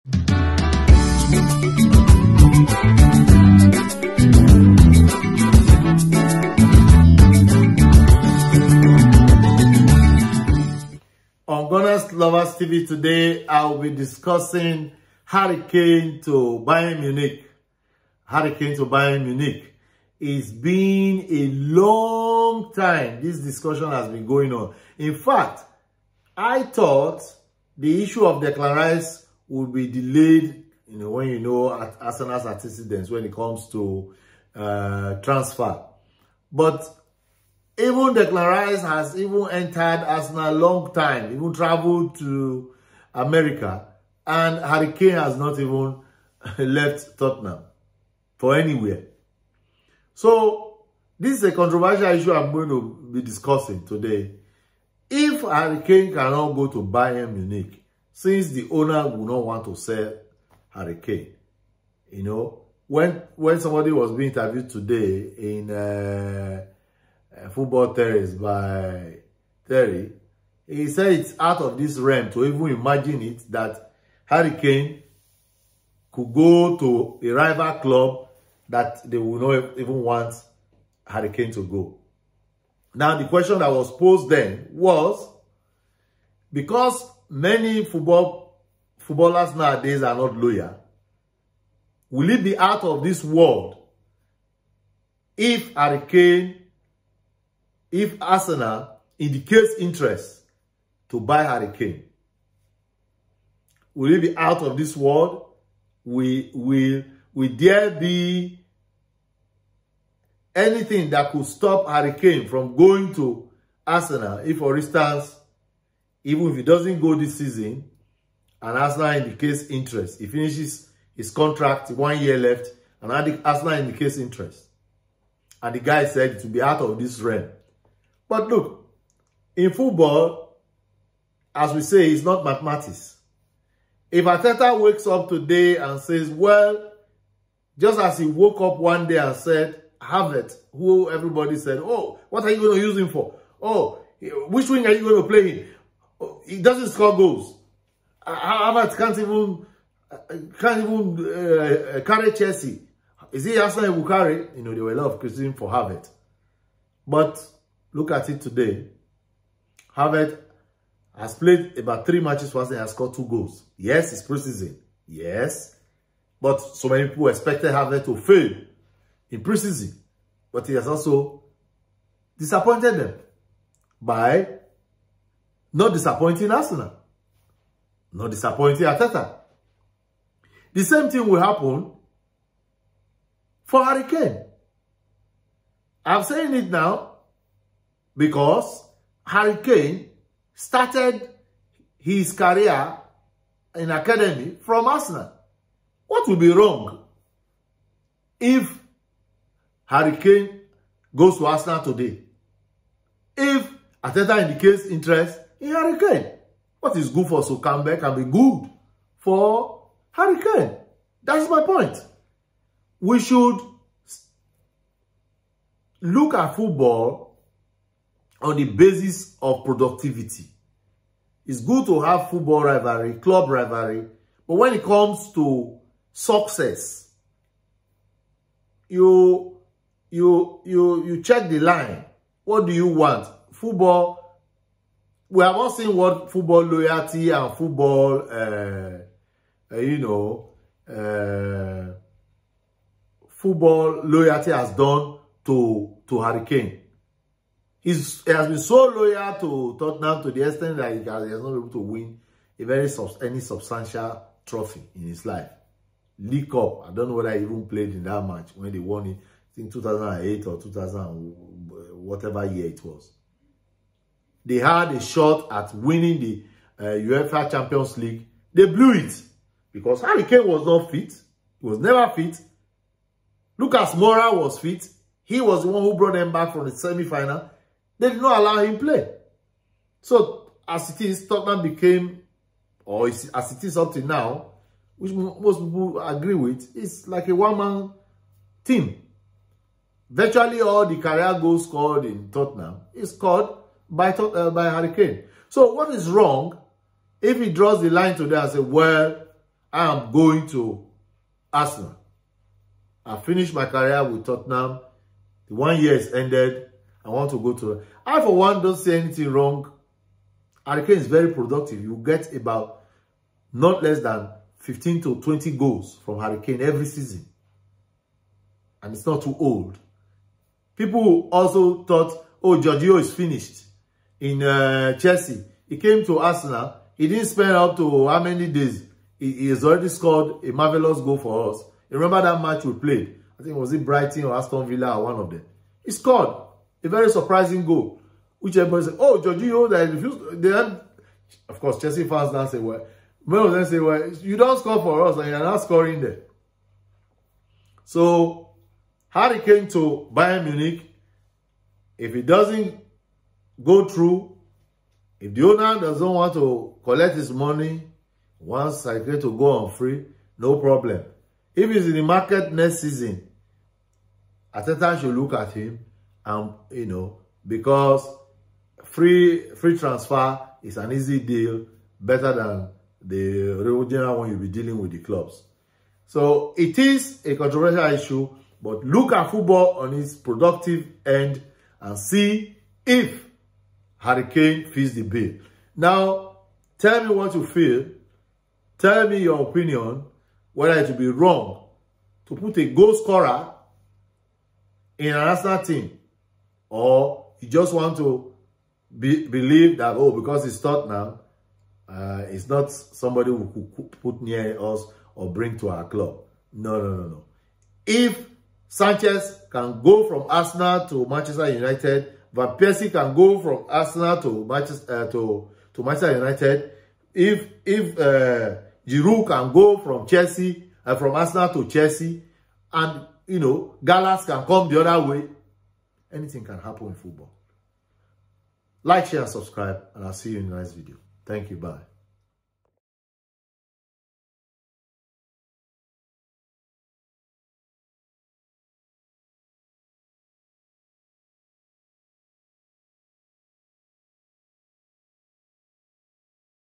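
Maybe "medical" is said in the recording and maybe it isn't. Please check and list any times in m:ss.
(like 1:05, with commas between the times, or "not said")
not said.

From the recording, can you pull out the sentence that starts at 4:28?
They blew it because Harry Kane was not fit.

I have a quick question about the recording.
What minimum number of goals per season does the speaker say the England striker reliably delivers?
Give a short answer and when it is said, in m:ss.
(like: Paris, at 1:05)
15, at 5:14.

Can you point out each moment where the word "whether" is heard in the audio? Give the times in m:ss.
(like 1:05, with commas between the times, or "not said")
4:17, 6:30.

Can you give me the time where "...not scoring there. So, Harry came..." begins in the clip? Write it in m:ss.
5:45.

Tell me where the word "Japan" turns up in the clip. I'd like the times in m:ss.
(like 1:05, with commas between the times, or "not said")
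not said.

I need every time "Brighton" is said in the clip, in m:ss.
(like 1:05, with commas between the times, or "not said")
5:33.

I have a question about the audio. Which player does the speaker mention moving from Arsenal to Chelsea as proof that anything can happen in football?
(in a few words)
Giroud.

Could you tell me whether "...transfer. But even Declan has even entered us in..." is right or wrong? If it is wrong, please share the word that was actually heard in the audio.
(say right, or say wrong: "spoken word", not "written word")
right.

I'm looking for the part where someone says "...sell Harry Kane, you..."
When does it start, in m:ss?
0:59.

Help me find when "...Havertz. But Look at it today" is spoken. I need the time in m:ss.
2:35.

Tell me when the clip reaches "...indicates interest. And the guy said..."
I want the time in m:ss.
2:03.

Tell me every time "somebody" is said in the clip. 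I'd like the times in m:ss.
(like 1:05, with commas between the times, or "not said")
1:03, 6:42.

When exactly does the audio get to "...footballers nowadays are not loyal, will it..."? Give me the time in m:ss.
1:28.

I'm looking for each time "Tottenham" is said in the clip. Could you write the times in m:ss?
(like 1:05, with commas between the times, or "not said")
0:47, 4:09, 4:41, 4:52, 5:04.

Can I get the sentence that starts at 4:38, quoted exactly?
They did not allow him play.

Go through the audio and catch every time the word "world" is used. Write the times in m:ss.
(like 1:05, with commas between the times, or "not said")
1:33, 1:44.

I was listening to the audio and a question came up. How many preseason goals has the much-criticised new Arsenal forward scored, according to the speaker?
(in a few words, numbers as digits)
2.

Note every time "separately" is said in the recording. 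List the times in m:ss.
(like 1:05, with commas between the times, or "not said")
not said.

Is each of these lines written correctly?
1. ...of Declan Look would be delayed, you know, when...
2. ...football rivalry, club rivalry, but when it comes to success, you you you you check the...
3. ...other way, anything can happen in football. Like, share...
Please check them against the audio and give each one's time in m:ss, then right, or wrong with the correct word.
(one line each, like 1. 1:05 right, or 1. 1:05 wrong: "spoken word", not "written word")
1. 0:28 wrong: "Rice", not "Look"
2. 3:42 right
3. 7:04 right.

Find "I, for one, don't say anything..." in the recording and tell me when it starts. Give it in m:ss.
5:08.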